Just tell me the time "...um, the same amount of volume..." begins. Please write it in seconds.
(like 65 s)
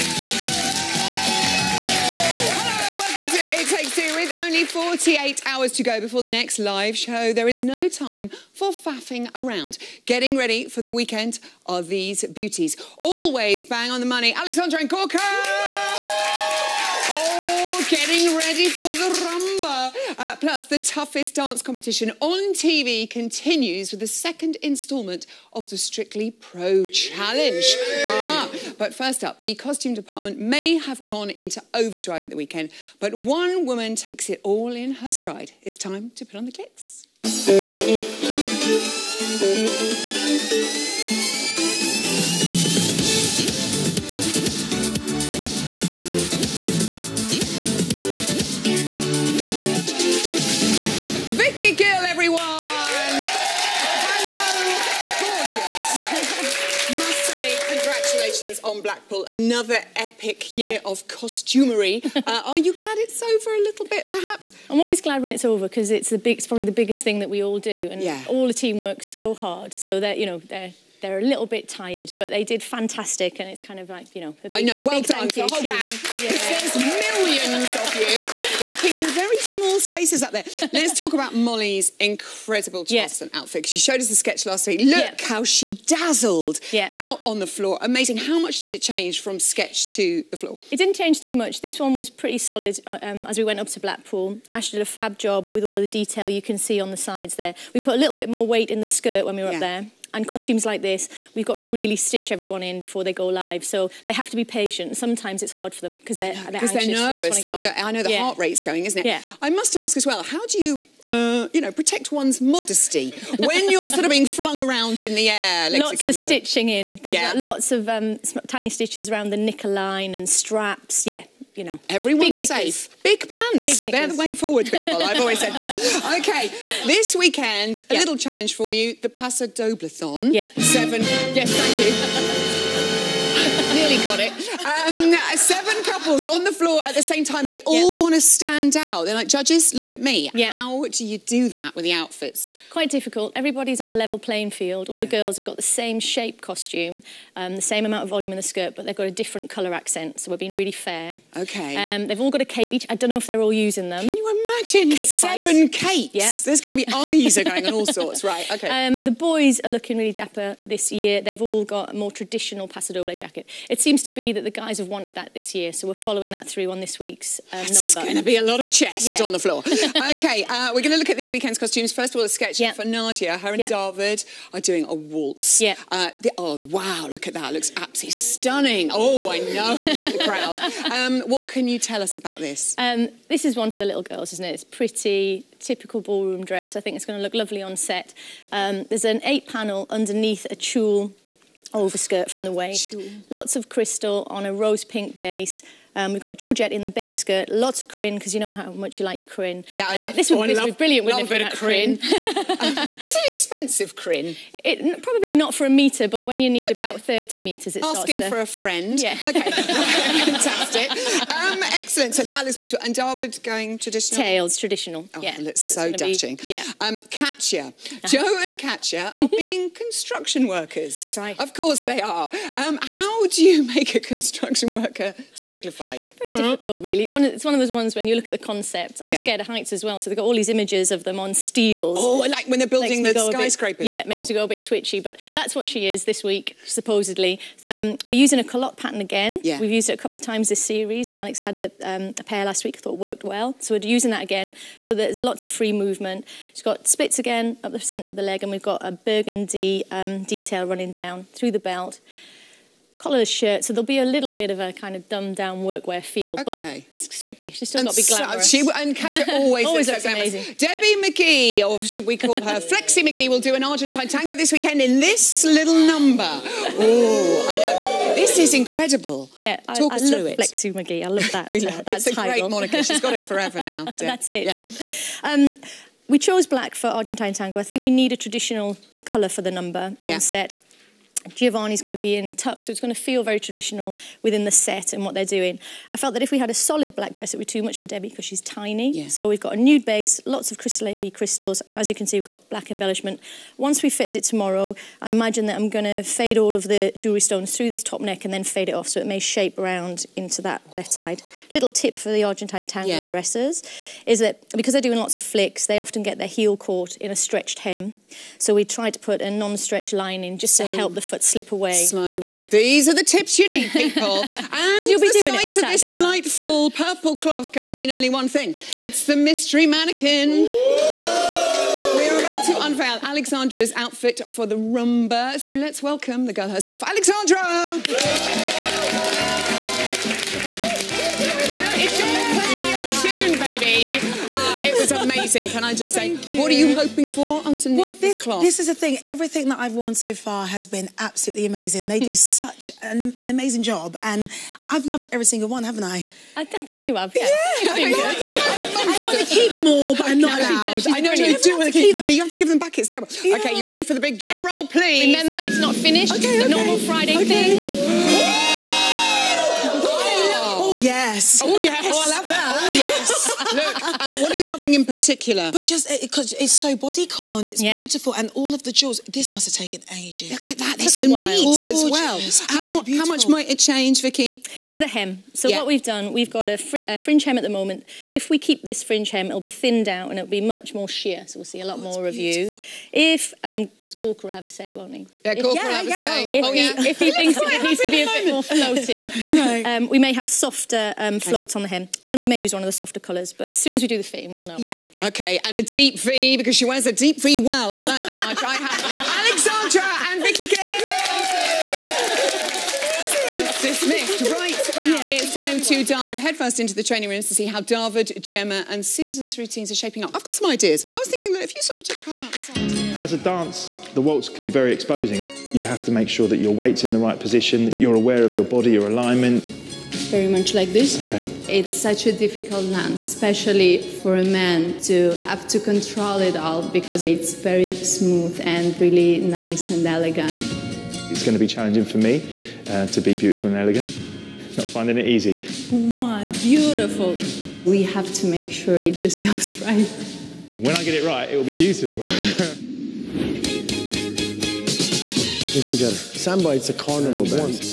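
147 s.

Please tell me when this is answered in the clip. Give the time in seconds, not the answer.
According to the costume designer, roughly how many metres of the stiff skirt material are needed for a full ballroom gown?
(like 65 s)
207 s.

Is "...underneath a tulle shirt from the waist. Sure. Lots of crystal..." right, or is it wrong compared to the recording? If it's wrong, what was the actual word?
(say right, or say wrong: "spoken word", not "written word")
wrong: "overskirt", not "shirt".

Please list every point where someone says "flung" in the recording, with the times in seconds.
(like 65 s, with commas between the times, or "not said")
114 s.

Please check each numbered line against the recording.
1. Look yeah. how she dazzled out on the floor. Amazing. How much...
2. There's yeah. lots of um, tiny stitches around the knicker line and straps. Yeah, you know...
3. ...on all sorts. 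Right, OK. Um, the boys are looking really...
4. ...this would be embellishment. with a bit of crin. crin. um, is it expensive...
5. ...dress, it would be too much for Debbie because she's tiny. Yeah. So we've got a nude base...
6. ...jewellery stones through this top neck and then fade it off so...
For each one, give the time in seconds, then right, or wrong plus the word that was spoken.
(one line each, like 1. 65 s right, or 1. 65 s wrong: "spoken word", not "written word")
1. 84 s right
2. 117 s right
3. 157 s right
4. 200 s wrong: "brilliant", not "embellishment"
5. 287 s right
6. 296 s right.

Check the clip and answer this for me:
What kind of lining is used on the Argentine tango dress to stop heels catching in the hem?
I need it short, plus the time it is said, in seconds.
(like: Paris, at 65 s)
Non-stretch lining, at 309 s.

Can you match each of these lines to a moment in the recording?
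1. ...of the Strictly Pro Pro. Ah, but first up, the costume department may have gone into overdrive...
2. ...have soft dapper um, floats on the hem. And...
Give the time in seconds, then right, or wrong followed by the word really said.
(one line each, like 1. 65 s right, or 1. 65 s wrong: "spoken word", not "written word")
1. 25 s wrong: "Challenge", not "Pro"
2. 390 s wrong: "softer", not "dapper".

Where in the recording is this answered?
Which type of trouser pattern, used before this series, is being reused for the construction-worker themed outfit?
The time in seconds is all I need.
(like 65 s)
238 s.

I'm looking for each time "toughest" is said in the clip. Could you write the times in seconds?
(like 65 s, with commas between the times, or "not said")
20 s.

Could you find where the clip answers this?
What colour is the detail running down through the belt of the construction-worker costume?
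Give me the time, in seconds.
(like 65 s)
248 s.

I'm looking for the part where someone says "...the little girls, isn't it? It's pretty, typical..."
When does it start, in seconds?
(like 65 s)
183 s.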